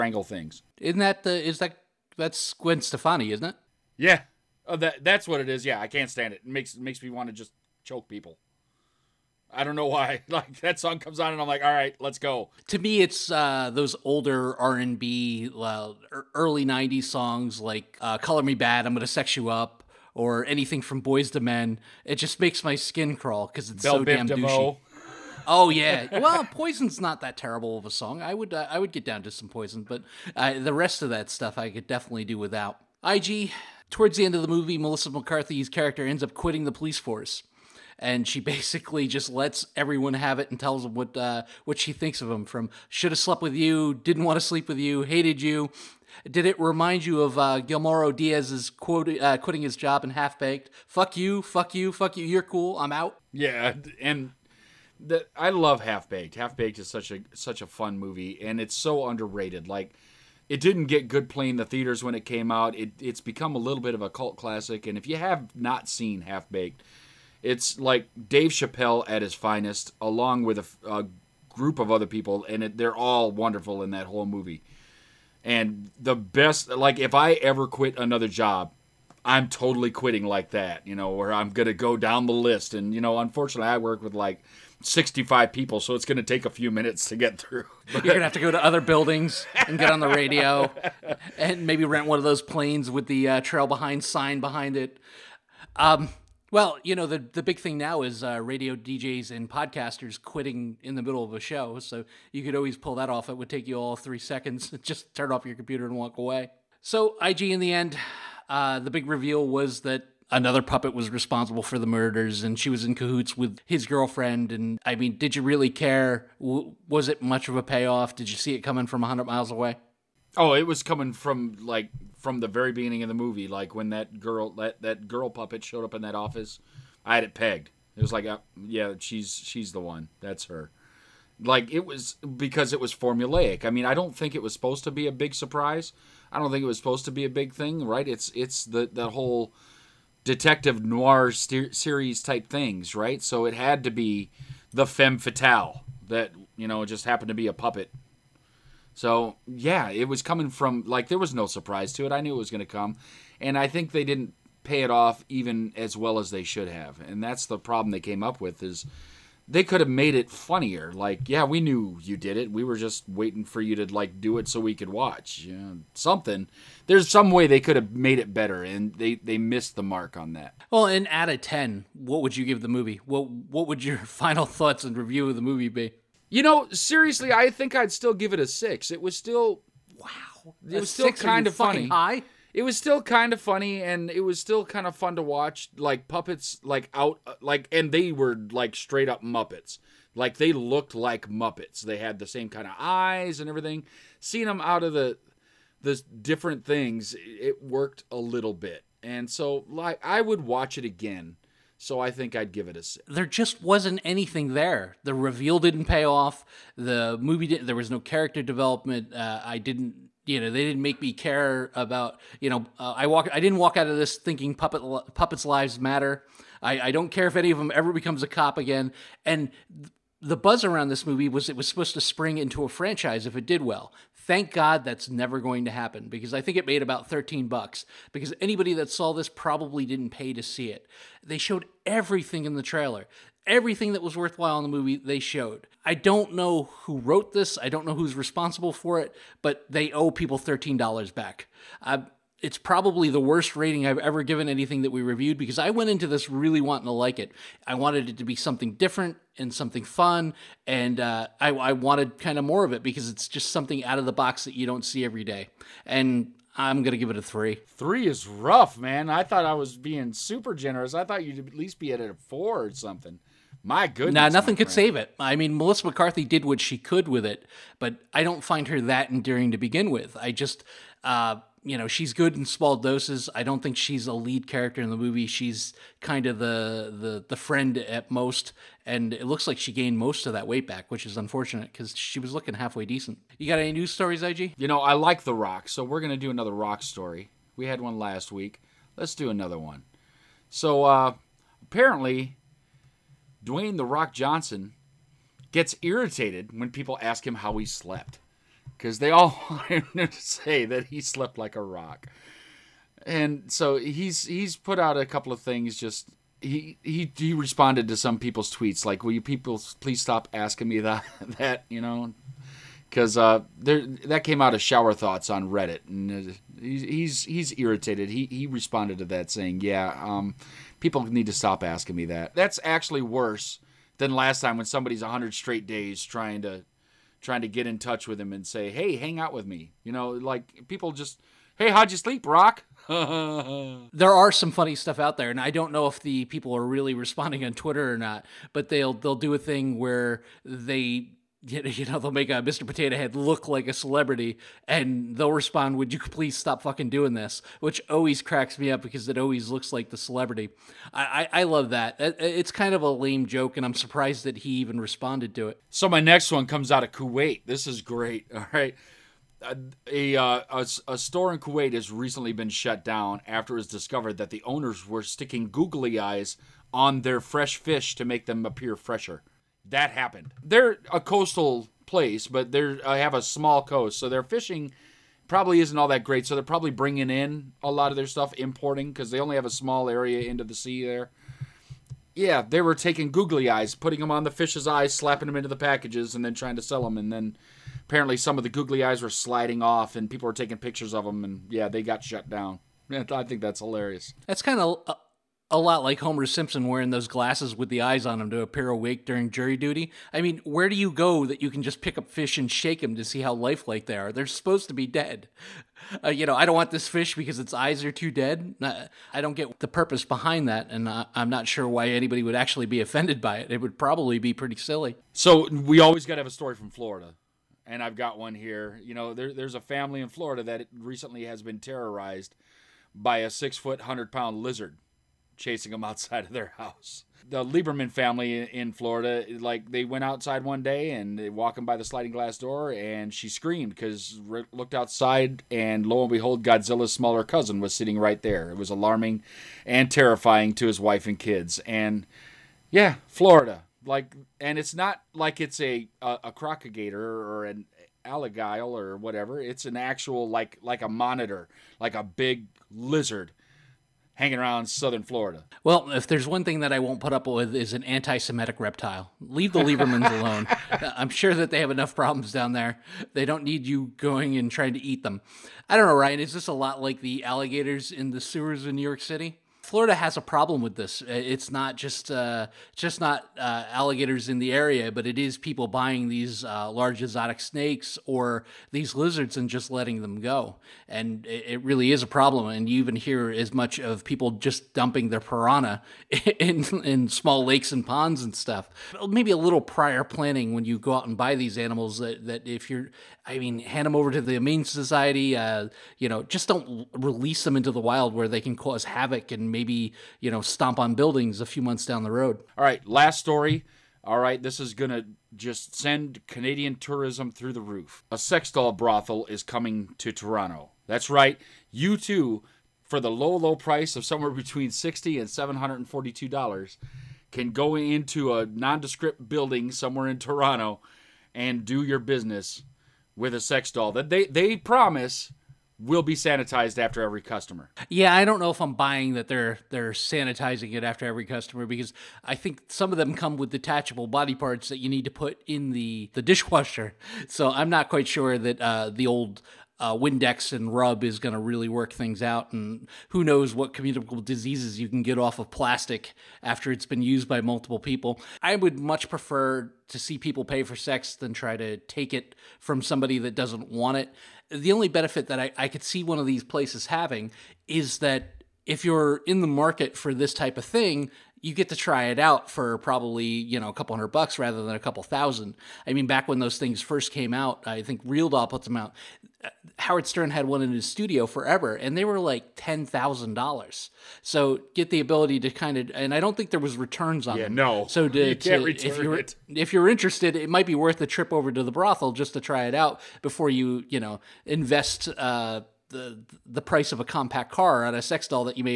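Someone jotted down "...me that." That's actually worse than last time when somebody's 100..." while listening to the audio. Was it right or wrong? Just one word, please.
right.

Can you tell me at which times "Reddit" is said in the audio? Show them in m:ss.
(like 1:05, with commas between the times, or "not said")
5:15.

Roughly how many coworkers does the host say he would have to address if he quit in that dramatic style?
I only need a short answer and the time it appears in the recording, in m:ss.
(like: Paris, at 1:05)
65, at 1:24.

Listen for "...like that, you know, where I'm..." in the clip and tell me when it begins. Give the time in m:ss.
1:20.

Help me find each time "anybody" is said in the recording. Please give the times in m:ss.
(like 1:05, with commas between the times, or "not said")
3:48, 6:51.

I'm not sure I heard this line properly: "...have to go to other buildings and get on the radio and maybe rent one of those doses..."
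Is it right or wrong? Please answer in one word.
wrong.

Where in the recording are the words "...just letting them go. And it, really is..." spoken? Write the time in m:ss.
7:59.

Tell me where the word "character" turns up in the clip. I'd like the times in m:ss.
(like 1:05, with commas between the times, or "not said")
0:35, 3:28, 4:34.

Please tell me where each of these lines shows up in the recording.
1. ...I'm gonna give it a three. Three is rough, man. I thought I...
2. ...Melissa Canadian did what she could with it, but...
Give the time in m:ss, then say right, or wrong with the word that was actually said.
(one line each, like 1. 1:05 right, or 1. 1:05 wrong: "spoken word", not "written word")
1. 4:16 right
2. 4:25 wrong: "McCarthy", not "Canadian".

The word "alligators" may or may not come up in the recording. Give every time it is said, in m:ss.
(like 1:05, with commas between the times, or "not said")
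7:28, 7:47, 7:53.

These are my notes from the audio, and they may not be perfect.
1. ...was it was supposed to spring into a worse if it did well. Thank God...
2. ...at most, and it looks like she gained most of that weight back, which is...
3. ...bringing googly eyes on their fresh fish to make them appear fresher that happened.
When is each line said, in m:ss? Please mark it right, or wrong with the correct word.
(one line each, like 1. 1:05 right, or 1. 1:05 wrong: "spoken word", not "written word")
1. 3:41 wrong: "franchise", not "worse"
2. 4:37 right
3. 6:05 wrong: "sticking", not "bringing".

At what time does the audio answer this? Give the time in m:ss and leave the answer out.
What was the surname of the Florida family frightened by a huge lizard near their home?
7:07.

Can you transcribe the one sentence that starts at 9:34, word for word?
So get the ability to kind of, and I don't think there was returns on yeah, them.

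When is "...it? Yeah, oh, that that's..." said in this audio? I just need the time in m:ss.
0:03.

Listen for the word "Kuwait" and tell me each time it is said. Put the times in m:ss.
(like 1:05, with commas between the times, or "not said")
5:56, 6:01.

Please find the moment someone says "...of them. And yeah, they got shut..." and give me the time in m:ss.
6:30.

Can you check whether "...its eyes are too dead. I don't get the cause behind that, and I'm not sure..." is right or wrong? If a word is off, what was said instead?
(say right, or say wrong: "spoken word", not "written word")
wrong: "purpose", not "cause".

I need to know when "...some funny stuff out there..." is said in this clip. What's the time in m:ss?
5:34.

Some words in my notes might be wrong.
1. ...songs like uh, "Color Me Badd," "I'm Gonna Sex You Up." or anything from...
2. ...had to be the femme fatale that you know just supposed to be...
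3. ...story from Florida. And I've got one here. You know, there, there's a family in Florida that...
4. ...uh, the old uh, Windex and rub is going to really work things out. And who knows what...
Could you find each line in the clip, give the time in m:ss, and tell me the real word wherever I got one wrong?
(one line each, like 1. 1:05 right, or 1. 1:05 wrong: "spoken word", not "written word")
1. 0:17 right
2. 2:23 wrong: "happened", not "supposed"
3. 6:56 right
4. 8:58 right.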